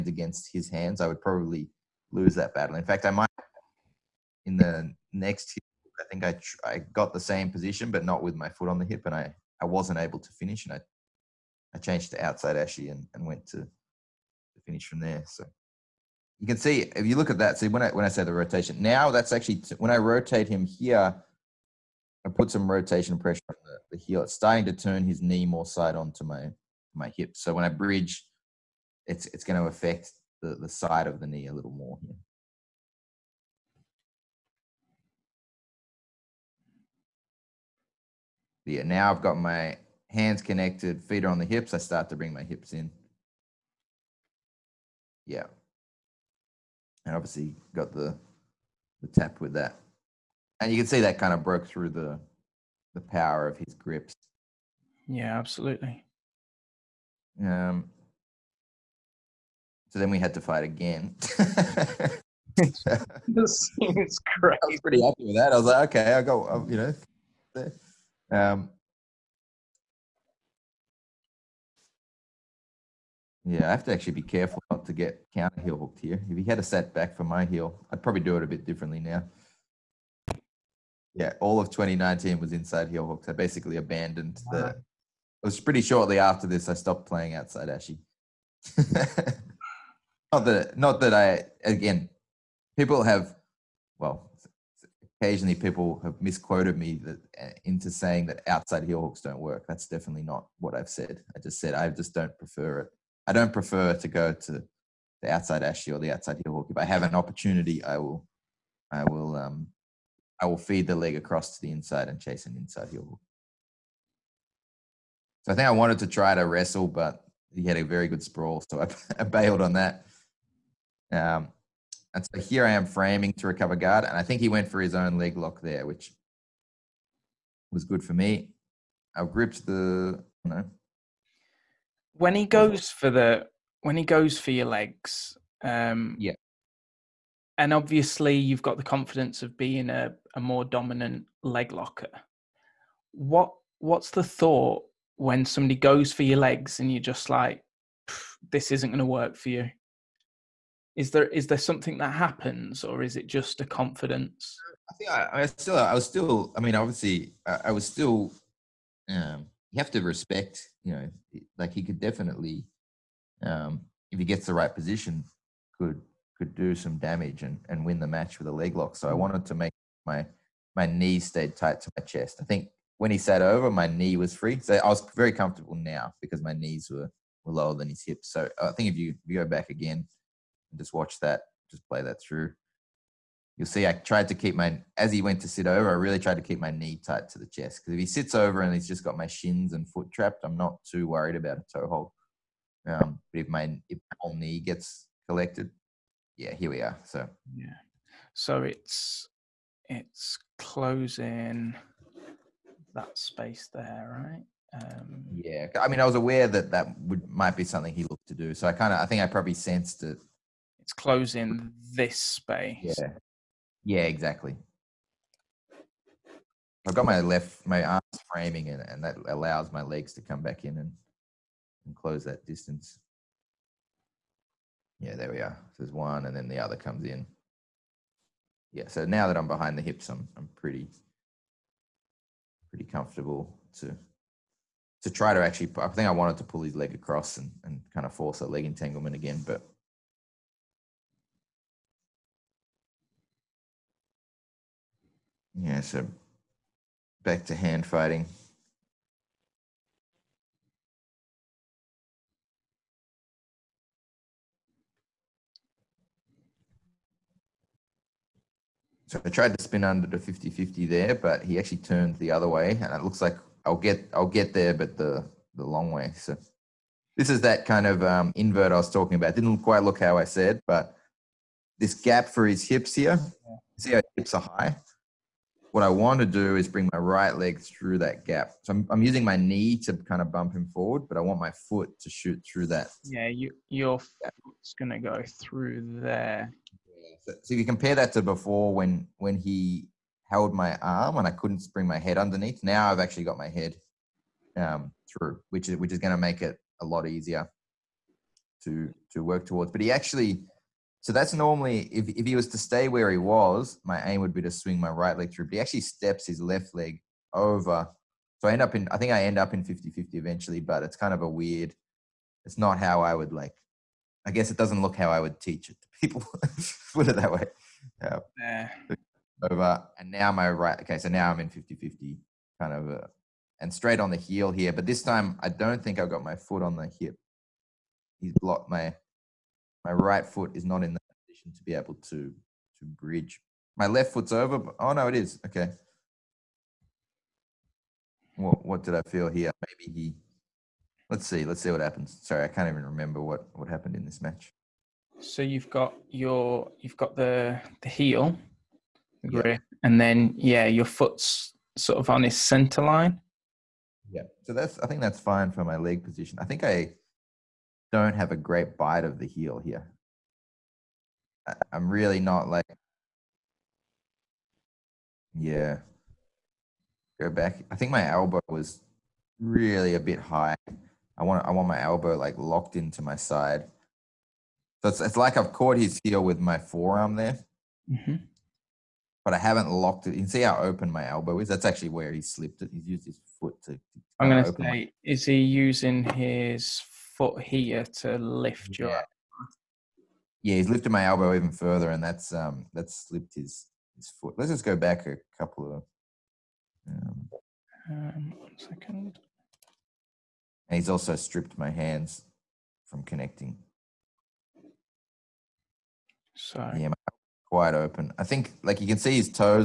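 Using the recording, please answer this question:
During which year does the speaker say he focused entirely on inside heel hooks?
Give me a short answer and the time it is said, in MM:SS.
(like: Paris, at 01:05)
2019, at 01:21.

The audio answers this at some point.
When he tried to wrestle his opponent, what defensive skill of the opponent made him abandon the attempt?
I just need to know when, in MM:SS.
01:57.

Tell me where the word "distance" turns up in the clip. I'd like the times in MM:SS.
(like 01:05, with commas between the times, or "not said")
03:42.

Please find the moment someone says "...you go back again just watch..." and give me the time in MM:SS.
02:59.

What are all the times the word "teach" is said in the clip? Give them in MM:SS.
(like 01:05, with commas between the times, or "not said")
05:15.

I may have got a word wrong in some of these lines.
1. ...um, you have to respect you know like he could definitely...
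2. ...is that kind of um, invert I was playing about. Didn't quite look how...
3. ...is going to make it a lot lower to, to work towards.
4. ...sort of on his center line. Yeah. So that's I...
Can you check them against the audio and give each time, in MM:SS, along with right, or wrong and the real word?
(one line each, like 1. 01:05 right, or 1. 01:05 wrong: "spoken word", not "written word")
1. 02:39 right
2. 04:27 wrong: "talking", not "playing"
3. 04:55 wrong: "easier", not "lower"
4. 05:51 right.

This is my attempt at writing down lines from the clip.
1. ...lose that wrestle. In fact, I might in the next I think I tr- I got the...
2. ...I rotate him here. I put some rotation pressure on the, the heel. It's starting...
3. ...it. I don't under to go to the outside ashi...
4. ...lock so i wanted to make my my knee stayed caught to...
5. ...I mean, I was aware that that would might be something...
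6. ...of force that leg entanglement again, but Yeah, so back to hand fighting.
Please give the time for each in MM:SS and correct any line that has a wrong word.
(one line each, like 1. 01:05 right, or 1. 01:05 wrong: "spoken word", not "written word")
1. 00:02 wrong: "battle", not "wrestle"
2. 00:19 right
3. 01:42 wrong: "prefer", not "under"
4. 02:48 wrong: "tight", not "caught"
5. 03:25 right
6. 03:58 right.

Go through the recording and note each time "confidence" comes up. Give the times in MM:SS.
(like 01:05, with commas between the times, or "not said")
02:18, 02:33.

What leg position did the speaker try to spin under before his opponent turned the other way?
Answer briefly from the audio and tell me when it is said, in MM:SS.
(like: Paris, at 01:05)
50-50, at 04:20.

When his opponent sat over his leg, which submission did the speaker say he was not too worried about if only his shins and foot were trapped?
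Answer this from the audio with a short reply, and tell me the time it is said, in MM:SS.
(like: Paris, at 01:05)
toe hold, at 03:11.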